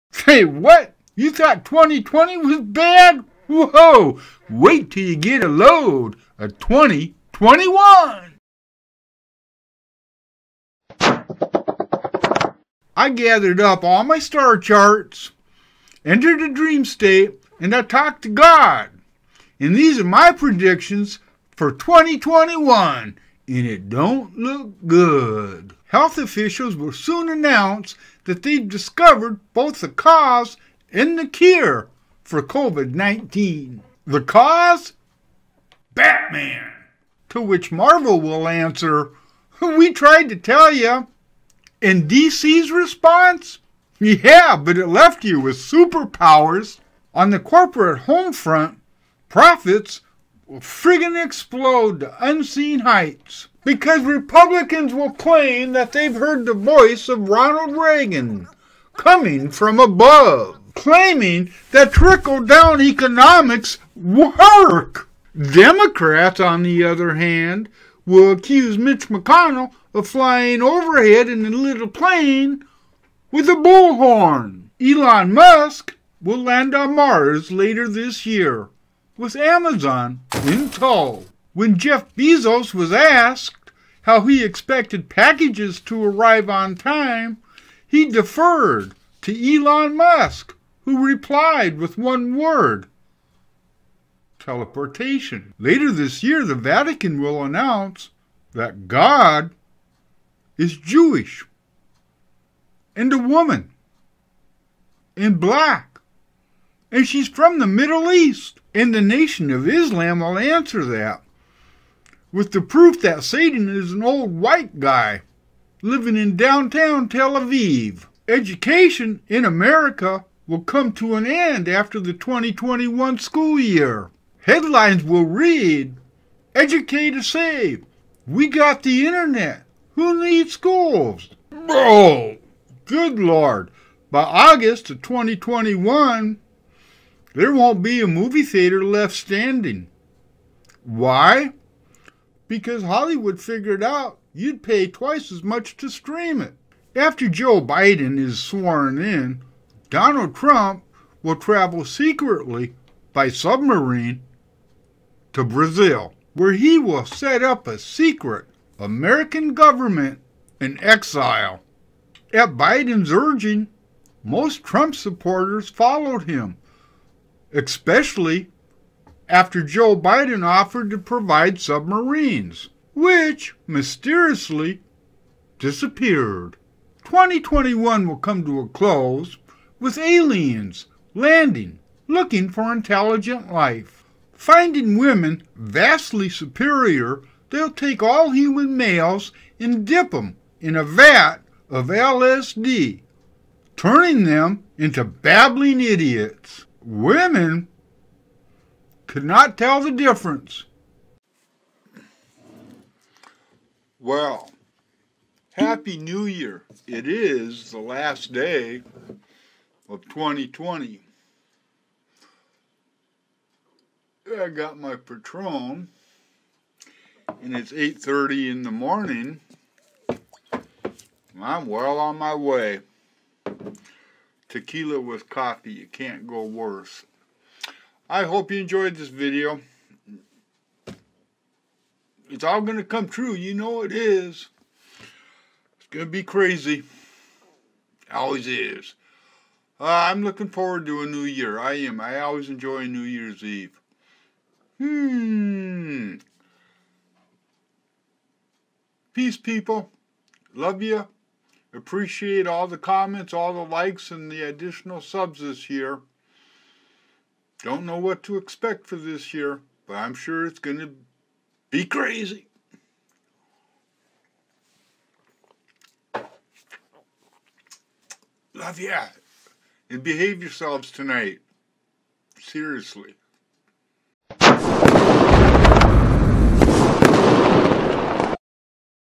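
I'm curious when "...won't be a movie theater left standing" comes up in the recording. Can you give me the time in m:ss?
2:17.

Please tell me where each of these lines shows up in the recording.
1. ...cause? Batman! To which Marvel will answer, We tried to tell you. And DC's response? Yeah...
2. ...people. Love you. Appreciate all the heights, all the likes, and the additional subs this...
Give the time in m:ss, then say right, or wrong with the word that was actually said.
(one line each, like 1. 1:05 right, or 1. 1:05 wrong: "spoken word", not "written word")
1. 0:34 right
2. 4:09 wrong: "comments", not "heights".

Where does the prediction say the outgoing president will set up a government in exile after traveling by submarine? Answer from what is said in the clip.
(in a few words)
Brazil.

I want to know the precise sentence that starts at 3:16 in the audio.
Women could not tell the difference.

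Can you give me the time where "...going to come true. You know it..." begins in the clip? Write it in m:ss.
3:52.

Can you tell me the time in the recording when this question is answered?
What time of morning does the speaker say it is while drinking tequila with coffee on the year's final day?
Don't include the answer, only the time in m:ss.
3:37.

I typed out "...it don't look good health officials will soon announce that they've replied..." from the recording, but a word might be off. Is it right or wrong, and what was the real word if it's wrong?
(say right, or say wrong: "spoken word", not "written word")
wrong: "discovered", not "replied".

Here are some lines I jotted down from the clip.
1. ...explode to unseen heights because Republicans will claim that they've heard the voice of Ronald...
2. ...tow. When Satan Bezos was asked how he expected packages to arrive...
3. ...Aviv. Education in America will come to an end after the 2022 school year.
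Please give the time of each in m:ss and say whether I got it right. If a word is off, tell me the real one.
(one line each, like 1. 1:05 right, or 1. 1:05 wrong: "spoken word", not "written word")
1. 0:51 right
2. 1:20 wrong: "Jeff", not "Satan"
3. 1:57 wrong: "2021", not "2022".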